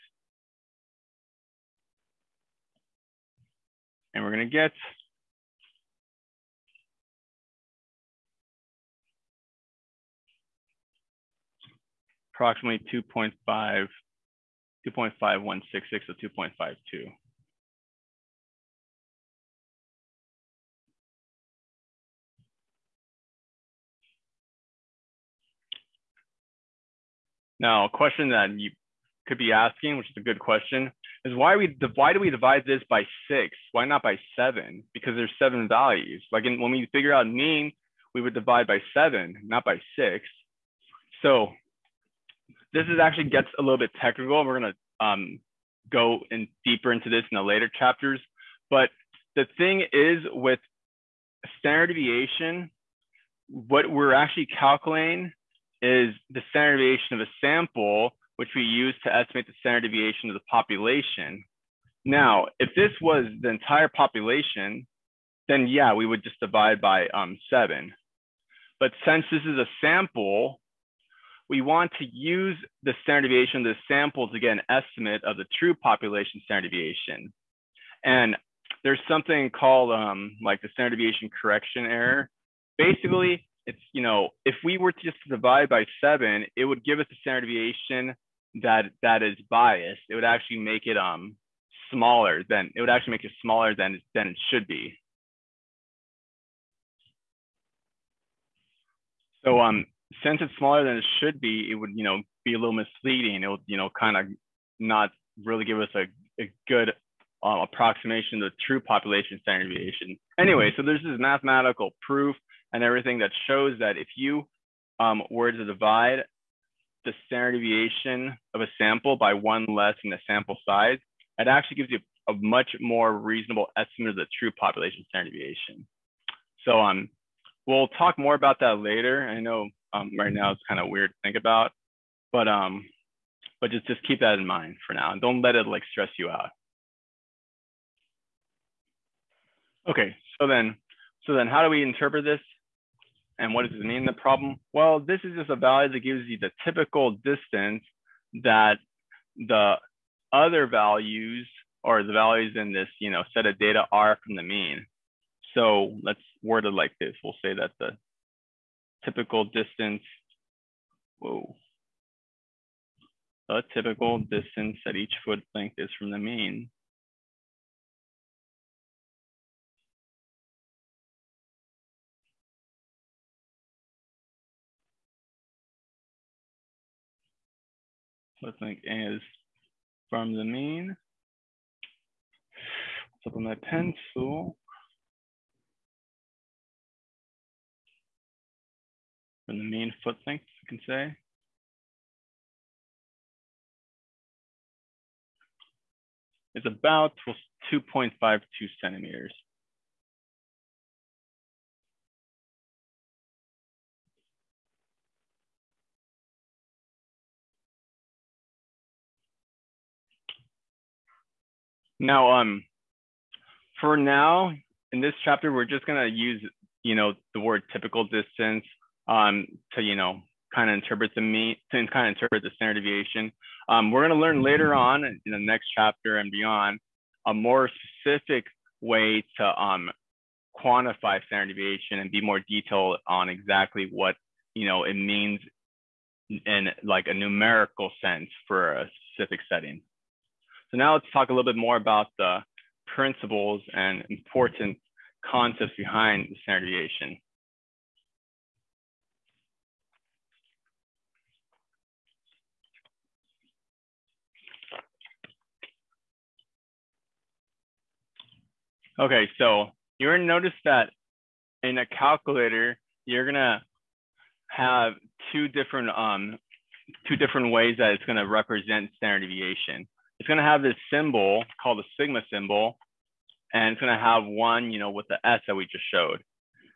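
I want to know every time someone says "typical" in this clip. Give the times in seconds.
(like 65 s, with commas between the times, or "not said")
146 s, 159 s, 163 s, 217 s.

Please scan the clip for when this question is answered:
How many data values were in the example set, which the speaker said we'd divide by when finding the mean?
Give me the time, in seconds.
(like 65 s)
35 s.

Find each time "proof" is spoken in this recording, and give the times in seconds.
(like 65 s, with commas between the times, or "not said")
112 s.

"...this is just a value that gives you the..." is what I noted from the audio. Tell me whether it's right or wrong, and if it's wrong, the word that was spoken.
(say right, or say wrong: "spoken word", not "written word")
right.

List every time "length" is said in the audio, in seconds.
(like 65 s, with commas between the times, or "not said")
165 s, 190 s.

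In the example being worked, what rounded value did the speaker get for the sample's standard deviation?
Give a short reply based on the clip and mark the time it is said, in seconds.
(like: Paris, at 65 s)
2.52, at 16 s.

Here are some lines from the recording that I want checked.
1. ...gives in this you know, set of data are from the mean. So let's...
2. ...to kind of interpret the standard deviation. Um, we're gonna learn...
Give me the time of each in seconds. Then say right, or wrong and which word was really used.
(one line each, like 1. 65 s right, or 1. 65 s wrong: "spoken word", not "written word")
1. 152 s wrong: "values", not "gives"
2. 221 s right.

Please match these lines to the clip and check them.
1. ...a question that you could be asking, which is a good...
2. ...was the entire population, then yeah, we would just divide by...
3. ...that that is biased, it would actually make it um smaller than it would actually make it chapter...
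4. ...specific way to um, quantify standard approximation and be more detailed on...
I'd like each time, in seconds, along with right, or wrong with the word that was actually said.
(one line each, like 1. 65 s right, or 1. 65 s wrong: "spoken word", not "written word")
1. 27 s right
2. 62 s right
3. 88 s wrong: "smaller", not "chapter"
4. 227 s wrong: "deviation", not "approximation".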